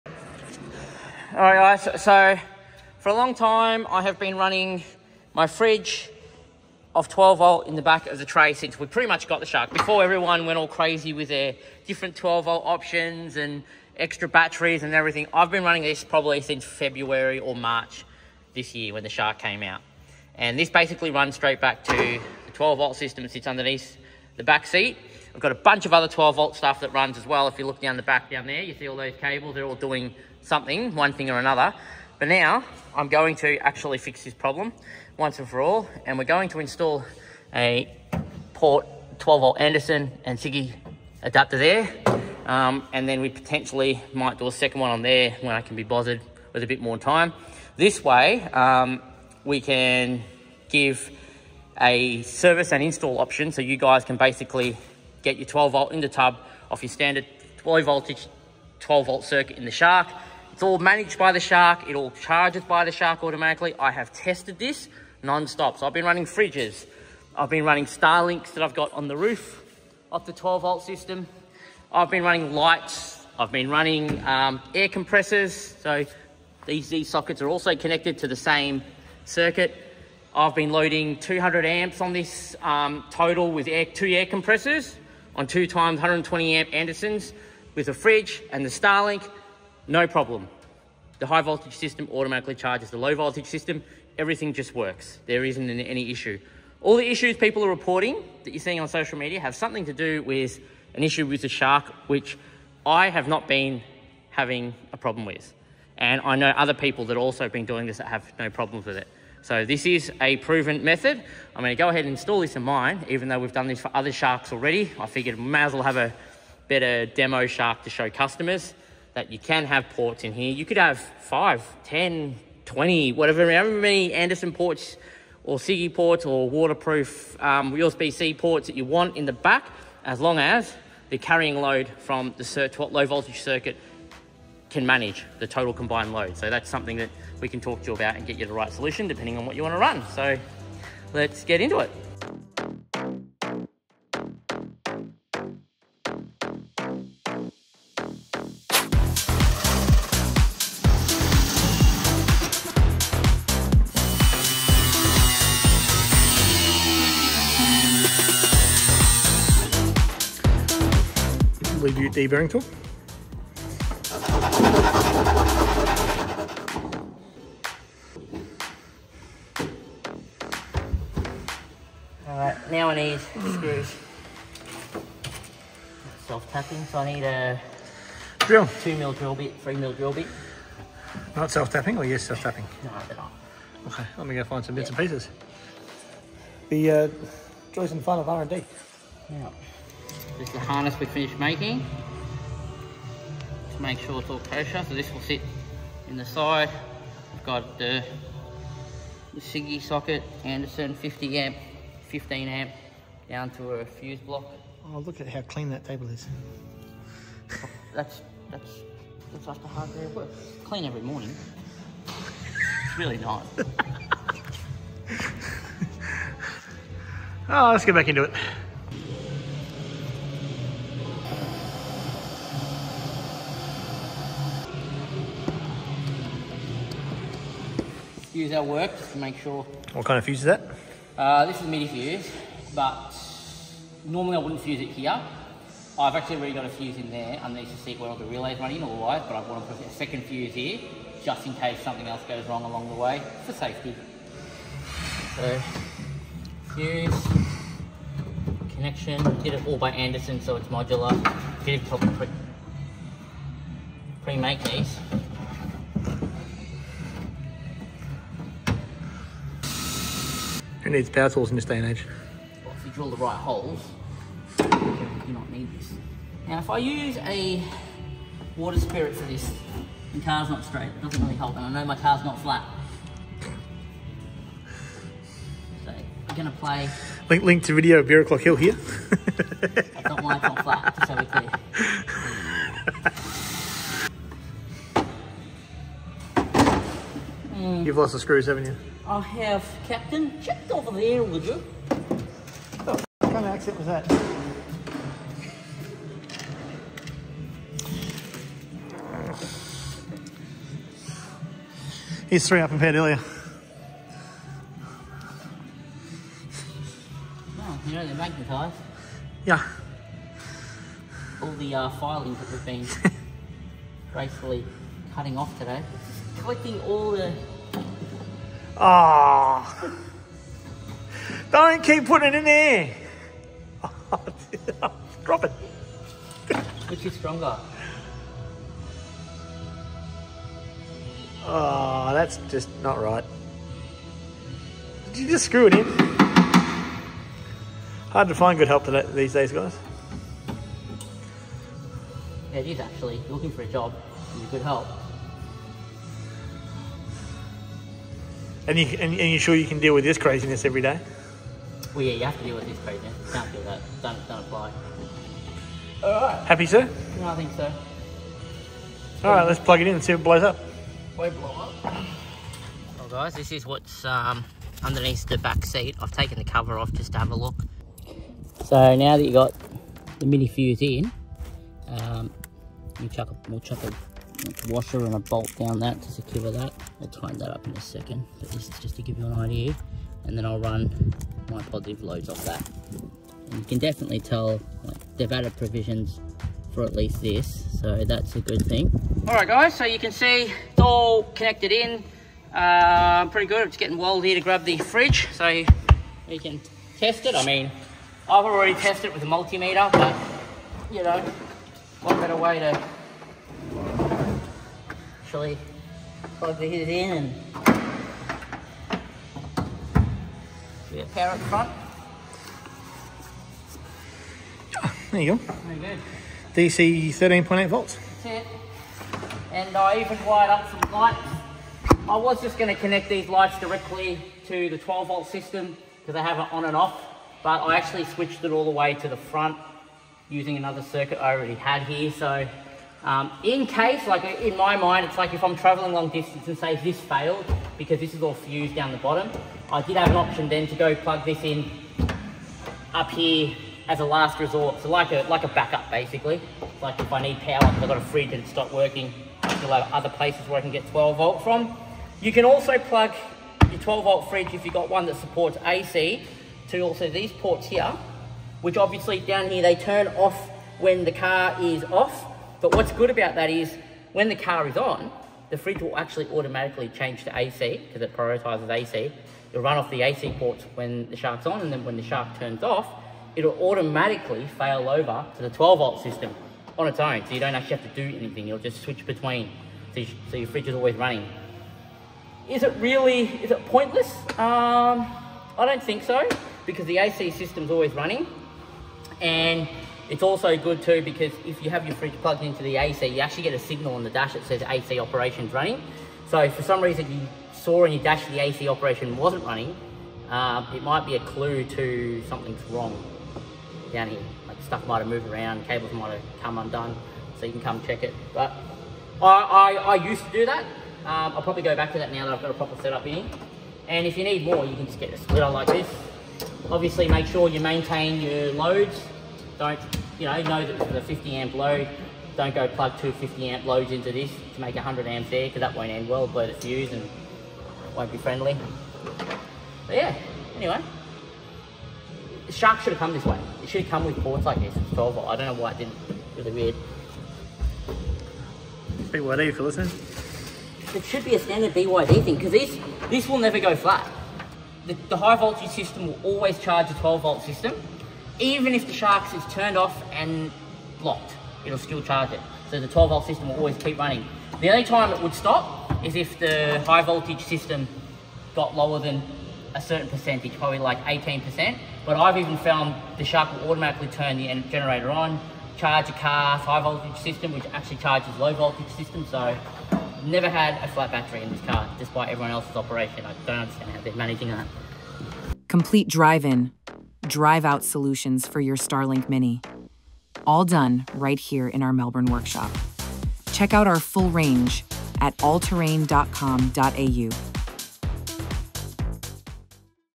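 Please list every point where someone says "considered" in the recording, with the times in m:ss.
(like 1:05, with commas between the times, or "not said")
not said.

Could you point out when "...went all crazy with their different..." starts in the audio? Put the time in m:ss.
0:10.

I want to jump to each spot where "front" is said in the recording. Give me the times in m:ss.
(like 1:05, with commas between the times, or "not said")
6:51, 7:09.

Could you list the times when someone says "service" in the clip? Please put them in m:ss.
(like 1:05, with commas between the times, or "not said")
0:52.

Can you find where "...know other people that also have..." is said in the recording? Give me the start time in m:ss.
1:46.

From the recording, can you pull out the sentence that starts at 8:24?
Like stuff might have moved around, cables might have come undone, so you can come check it.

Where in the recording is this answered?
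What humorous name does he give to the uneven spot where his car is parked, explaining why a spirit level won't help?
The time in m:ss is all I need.
4:38.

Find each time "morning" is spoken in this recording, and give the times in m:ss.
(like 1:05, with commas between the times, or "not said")
3:31.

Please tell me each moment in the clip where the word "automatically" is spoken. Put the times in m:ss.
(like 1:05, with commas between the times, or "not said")
1:03, 1:32, 7:46, 7:53, 9:23.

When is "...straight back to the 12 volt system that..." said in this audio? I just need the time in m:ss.
0:21.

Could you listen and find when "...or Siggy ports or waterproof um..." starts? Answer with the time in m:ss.
2:05.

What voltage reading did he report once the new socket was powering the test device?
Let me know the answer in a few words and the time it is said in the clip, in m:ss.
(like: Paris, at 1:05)
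13.8 volts, at 6:57.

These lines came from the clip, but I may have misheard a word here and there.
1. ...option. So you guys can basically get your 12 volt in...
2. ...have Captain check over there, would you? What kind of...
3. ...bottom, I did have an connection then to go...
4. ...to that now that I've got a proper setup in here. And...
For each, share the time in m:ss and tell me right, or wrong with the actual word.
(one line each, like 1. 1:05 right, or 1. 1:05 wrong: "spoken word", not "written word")
1. 0:53 right
2. 4:49 right
3. 7:18 wrong: "option", not "connection"
4. 8:31 right.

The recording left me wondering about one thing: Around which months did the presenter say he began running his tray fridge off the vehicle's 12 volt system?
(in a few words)
February or March.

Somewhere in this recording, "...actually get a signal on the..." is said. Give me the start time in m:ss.
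8:13.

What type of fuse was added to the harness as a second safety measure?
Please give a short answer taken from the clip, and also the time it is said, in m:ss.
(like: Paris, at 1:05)
MIDI fuse, at 3:51.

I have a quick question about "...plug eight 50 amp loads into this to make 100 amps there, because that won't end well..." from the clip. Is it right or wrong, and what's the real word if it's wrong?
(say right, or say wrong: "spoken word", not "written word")
wrong: "two", not "eight".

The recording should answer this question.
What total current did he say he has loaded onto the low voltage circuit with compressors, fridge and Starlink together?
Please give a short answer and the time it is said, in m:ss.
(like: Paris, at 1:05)
200 amps, at 1:21.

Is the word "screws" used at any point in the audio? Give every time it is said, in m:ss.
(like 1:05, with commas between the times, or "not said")
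2:53, 4:48, 5:35.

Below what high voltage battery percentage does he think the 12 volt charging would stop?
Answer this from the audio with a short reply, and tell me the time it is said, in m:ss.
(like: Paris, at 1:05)
18%, at 9:21.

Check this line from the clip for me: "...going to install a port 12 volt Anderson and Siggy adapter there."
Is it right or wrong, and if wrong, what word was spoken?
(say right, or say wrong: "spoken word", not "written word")
right.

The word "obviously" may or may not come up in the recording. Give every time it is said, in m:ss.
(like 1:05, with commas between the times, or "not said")
7:38, 8:36.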